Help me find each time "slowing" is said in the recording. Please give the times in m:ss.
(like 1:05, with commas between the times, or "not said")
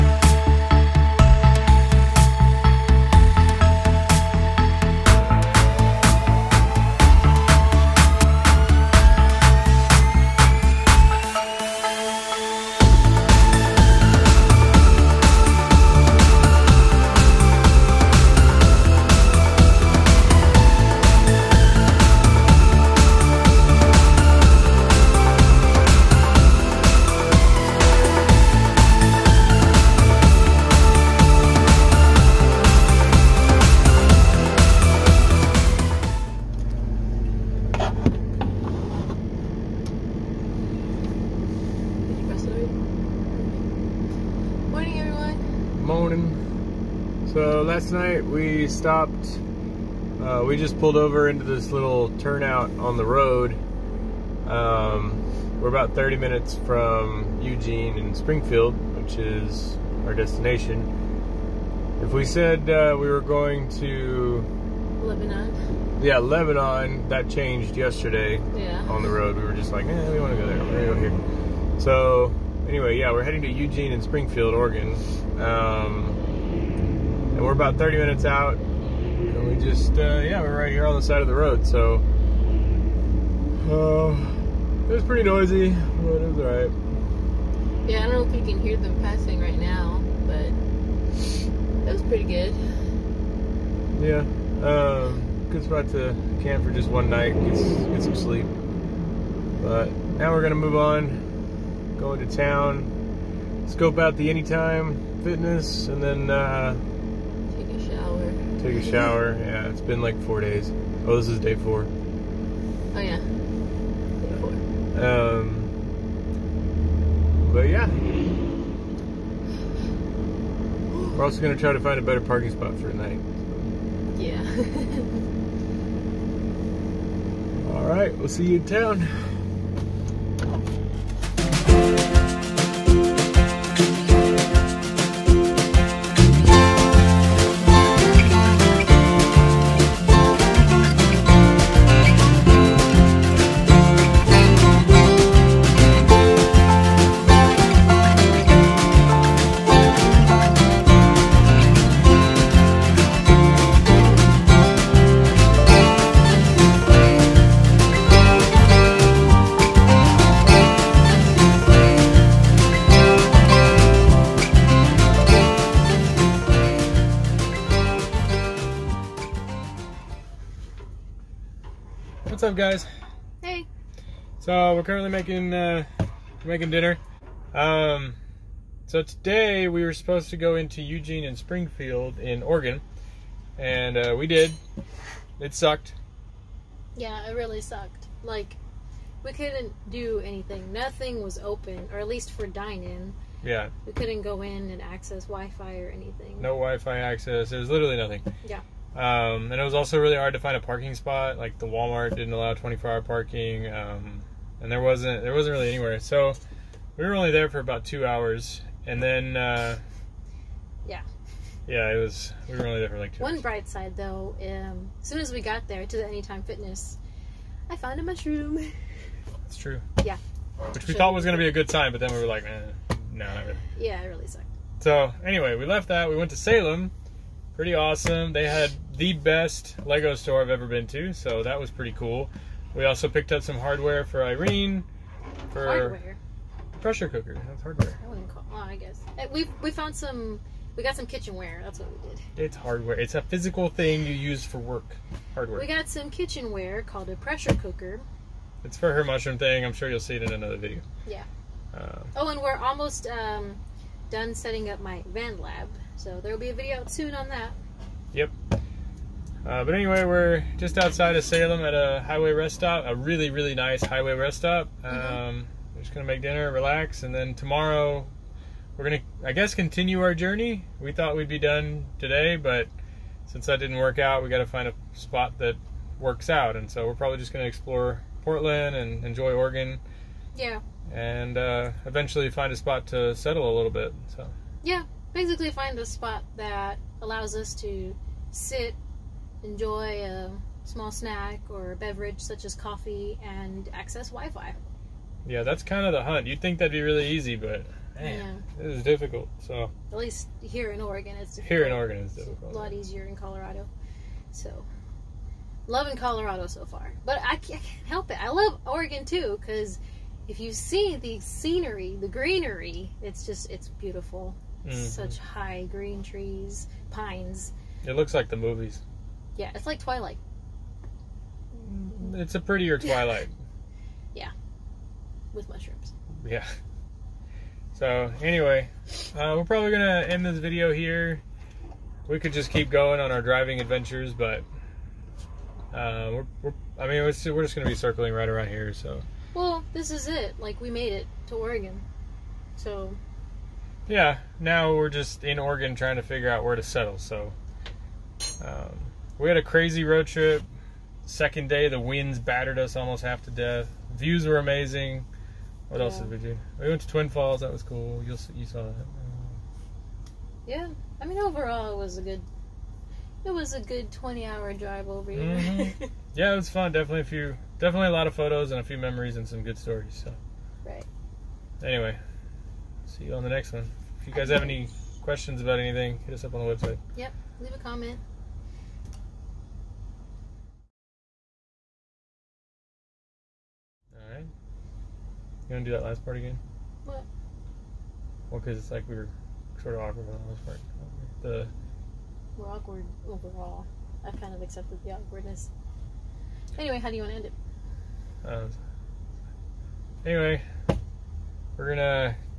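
not said.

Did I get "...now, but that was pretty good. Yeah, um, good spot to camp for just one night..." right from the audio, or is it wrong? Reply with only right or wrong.
right.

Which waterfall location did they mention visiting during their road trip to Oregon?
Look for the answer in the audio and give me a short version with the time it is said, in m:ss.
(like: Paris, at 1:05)
Twin Falls, at 5:56.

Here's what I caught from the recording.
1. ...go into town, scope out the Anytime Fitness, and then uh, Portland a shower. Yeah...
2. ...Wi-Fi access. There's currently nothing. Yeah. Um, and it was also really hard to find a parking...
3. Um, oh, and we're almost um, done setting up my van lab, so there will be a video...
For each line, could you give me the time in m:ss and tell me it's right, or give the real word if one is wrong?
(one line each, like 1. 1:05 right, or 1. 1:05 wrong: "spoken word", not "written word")
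1. 1:41 wrong: "Take", not "Portland"
2. 3:16 wrong: "literally", not "currently"
3. 4:11 right.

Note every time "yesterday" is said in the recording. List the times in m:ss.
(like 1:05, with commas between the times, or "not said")
1:07.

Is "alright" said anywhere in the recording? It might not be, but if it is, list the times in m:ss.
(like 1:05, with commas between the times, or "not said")
1:26.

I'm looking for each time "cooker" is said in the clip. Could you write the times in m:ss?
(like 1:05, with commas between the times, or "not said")
3:57, 4:07.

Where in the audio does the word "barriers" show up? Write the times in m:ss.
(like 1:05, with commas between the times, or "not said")
not said.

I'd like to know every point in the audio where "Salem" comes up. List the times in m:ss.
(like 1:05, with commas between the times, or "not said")
3:46, 4:21.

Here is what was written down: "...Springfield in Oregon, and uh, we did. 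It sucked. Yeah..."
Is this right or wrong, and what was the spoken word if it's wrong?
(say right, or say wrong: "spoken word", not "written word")
right.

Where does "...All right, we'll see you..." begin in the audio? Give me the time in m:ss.
2:07.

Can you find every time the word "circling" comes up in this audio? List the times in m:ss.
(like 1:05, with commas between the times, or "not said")
5:37.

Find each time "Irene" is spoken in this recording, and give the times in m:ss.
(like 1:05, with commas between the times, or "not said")
3:54.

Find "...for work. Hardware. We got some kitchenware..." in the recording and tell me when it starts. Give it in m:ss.
4:04.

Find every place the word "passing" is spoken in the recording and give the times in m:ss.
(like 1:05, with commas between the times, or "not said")
1:29.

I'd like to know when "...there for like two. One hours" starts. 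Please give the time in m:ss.
3:32.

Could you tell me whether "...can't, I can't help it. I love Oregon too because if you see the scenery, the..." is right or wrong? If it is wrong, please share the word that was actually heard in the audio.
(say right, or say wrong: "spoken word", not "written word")
right.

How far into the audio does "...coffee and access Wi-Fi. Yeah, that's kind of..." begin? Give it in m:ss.
4:52.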